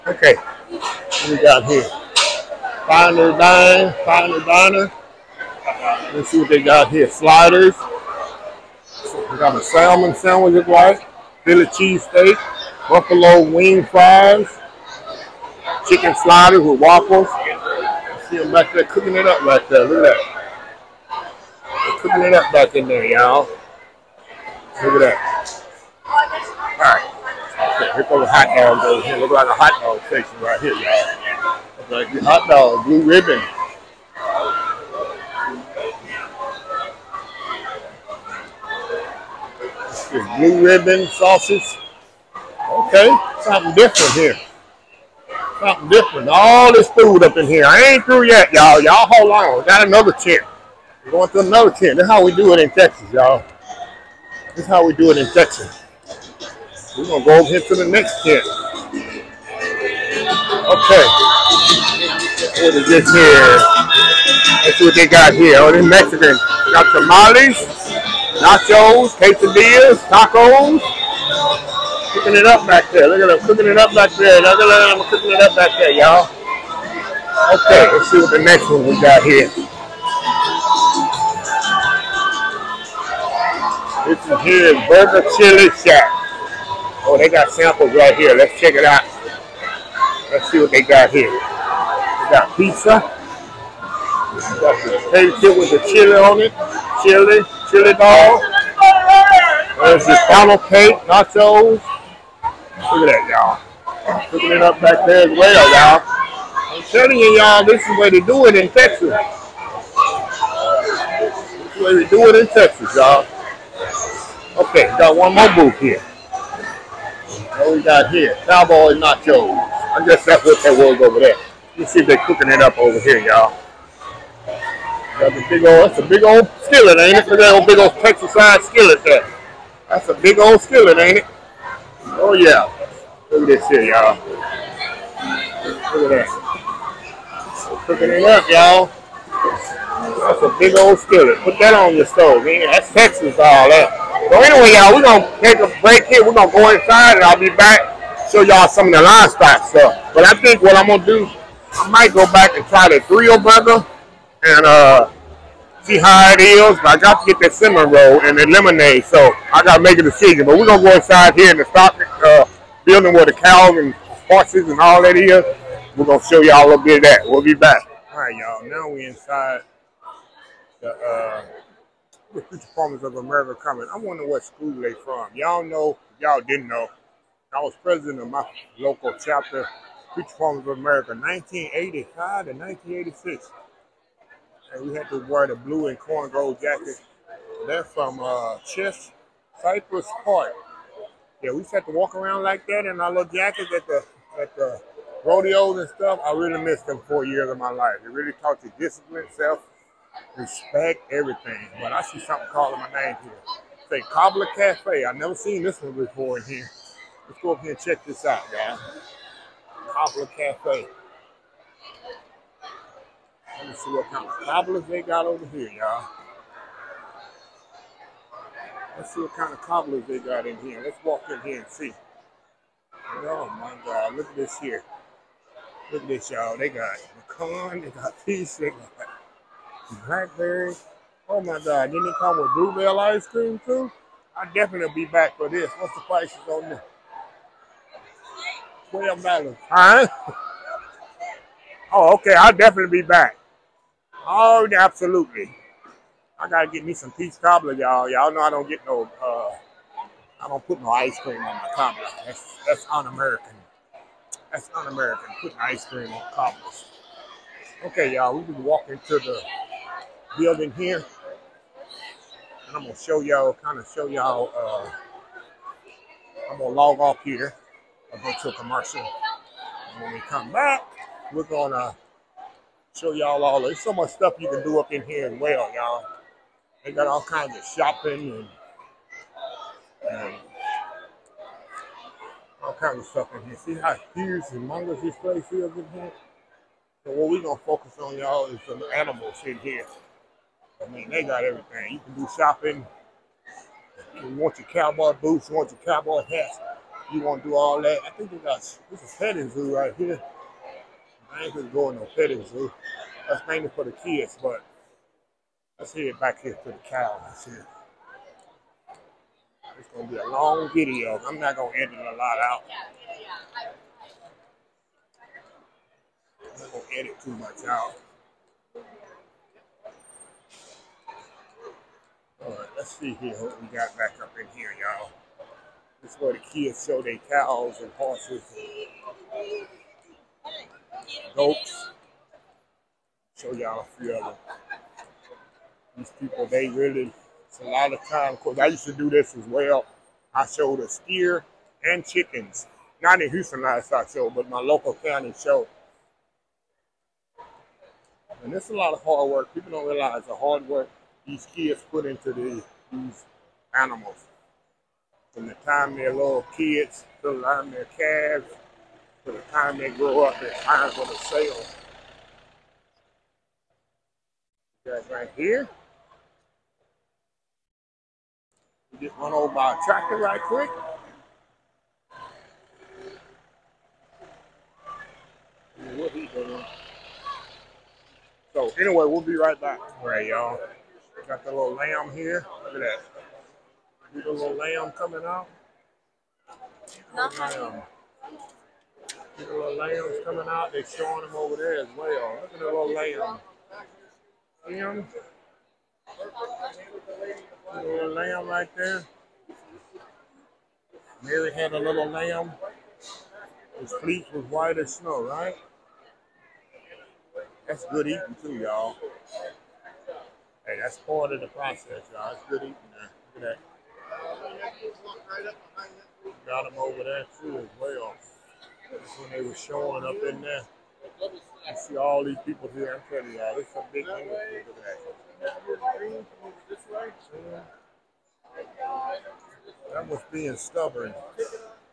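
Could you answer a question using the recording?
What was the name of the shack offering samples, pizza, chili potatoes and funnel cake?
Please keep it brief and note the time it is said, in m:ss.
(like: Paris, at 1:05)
Burger Chili Shack, at 1:24.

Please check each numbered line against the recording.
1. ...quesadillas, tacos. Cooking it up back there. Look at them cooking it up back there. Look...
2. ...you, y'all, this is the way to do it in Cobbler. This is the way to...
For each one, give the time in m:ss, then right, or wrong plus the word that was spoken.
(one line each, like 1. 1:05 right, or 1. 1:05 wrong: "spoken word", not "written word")
1. 1:09 right
2. 1:47 wrong: "Texas", not "Cobbler".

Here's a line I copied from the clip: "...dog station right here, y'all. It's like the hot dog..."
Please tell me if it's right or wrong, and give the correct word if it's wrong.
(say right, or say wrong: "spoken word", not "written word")
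right.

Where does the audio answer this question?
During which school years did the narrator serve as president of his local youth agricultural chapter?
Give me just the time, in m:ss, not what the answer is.
3:01.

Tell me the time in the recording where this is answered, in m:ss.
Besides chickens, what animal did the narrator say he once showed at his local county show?
5:40.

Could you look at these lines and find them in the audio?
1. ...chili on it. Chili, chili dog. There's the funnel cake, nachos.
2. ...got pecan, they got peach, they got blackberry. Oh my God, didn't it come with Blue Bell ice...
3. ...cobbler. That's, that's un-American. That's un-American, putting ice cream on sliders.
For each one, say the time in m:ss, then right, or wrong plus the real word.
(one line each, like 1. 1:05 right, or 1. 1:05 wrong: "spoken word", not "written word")
1. 1:35 right
2. 3:46 right
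3. 4:11 wrong: "cobblers", not "sliders".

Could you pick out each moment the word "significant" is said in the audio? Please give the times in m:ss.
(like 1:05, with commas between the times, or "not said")
not said.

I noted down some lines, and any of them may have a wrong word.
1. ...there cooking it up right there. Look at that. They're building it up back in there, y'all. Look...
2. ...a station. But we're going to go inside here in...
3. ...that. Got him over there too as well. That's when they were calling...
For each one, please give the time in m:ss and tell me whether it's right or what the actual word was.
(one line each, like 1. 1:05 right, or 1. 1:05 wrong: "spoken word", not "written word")
1. 0:18 wrong: "cooking", not "building"
2. 2:39 wrong: "decision", not "station"
3. 6:55 wrong: "showing", not "calling".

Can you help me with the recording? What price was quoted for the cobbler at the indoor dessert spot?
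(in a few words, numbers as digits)
$12.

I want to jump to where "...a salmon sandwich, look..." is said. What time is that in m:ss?
0:09.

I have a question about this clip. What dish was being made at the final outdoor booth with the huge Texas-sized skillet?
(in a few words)
Cowboy nachos.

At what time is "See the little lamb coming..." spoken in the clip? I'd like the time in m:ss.
6:24.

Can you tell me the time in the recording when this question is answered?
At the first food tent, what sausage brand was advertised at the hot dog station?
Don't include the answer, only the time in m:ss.
0:40.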